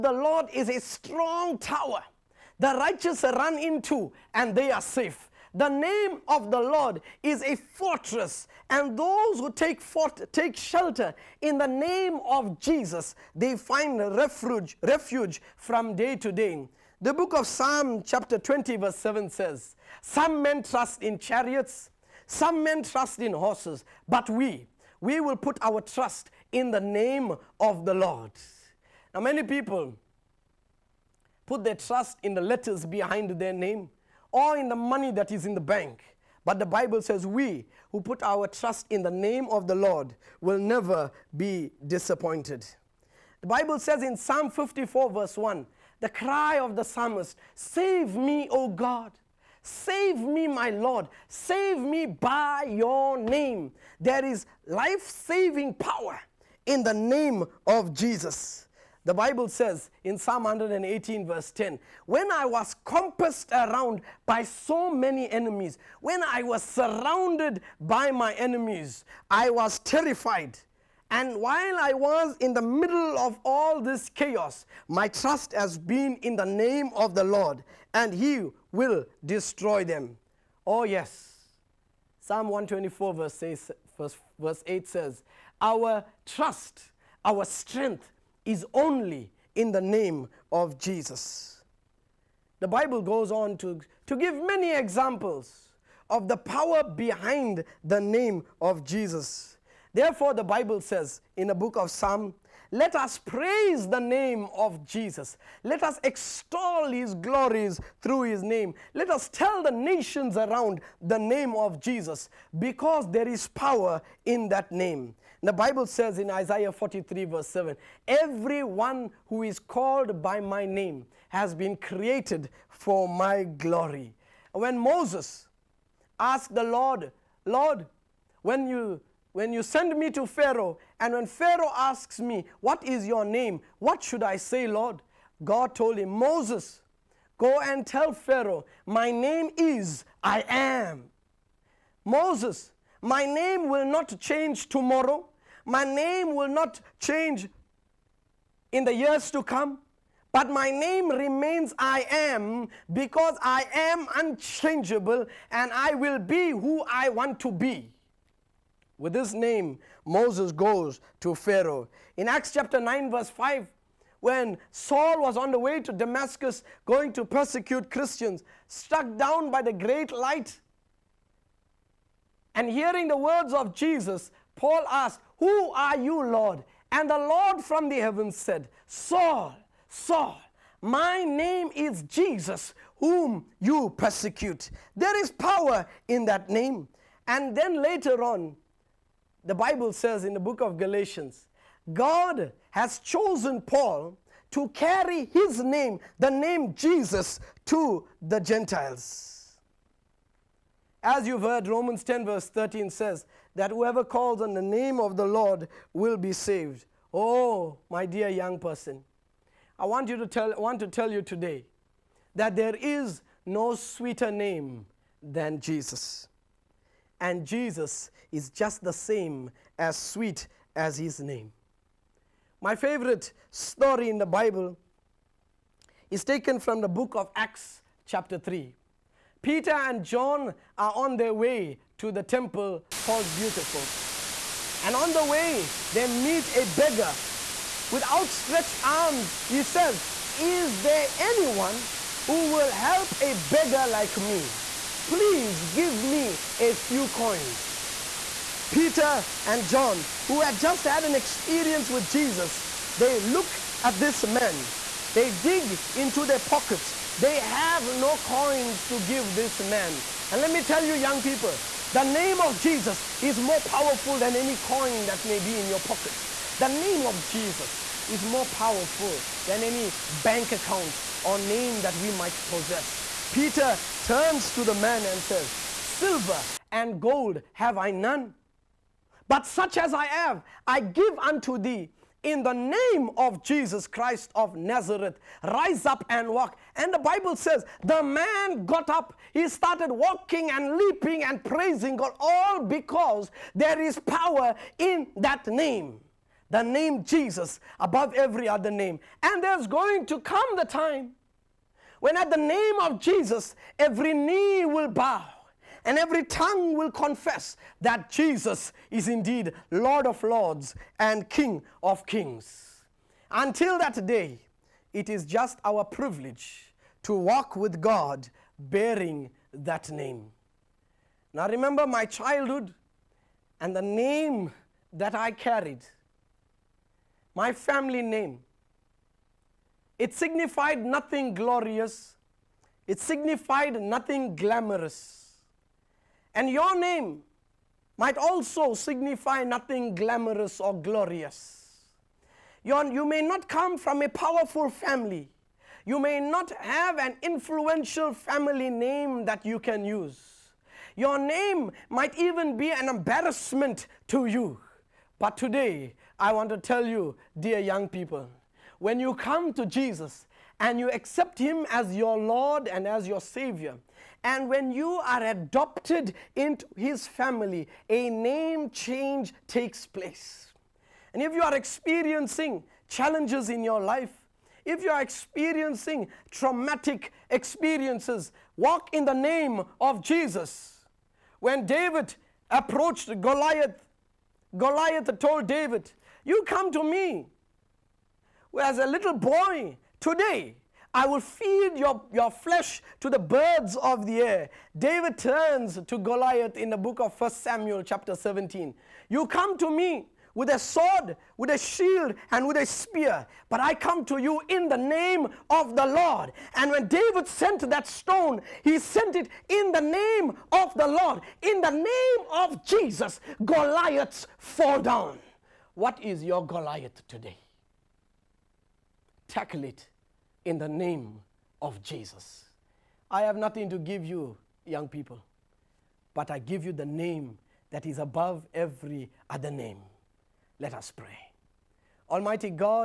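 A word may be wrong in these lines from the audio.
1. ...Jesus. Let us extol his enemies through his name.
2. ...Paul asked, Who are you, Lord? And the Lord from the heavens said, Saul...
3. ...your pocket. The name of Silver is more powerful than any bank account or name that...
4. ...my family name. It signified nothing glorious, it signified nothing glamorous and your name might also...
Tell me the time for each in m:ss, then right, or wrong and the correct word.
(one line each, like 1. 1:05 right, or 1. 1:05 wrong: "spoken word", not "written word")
1. 1:44 wrong: "glories", not "enemies"
2. 2:54 right
3. 4:25 wrong: "Jesus", not "Silver"
4. 5:27 right.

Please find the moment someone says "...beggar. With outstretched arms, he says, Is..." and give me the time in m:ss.
3:56.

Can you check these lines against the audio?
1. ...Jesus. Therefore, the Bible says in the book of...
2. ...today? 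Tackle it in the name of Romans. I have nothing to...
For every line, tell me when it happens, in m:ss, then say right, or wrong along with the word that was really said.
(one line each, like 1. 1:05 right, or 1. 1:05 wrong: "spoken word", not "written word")
1. 1:38 right
2. 6:57 wrong: "Jesus", not "Romans".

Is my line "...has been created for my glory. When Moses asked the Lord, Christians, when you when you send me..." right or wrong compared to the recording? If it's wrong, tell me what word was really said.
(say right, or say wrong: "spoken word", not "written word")
wrong: "Lord", not "Christians".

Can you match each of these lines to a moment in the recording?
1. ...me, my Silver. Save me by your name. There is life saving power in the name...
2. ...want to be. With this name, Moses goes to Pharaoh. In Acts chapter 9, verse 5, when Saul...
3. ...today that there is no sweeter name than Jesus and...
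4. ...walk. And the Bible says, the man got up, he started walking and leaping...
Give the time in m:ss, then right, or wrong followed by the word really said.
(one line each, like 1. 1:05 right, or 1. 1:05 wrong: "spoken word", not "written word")
1. 0:50 wrong: "Lord", not "Silver"
2. 2:37 right
3. 3:31 right
4. 4:46 right.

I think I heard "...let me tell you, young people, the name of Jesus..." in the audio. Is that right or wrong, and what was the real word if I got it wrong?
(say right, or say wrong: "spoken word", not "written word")
right.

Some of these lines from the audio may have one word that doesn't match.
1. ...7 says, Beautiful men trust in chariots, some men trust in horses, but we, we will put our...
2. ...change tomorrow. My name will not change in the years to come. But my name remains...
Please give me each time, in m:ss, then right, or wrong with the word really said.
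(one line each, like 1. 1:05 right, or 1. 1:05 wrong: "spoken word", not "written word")
1. 0:18 wrong: "Some", not "Beautiful"
2. 2:24 right.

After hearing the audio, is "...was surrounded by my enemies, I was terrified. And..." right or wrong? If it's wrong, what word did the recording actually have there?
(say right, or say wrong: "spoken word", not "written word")
right.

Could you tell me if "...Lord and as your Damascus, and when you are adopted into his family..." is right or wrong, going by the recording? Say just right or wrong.
wrong.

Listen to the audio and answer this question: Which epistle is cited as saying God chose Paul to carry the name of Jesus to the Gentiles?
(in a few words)
Galatians.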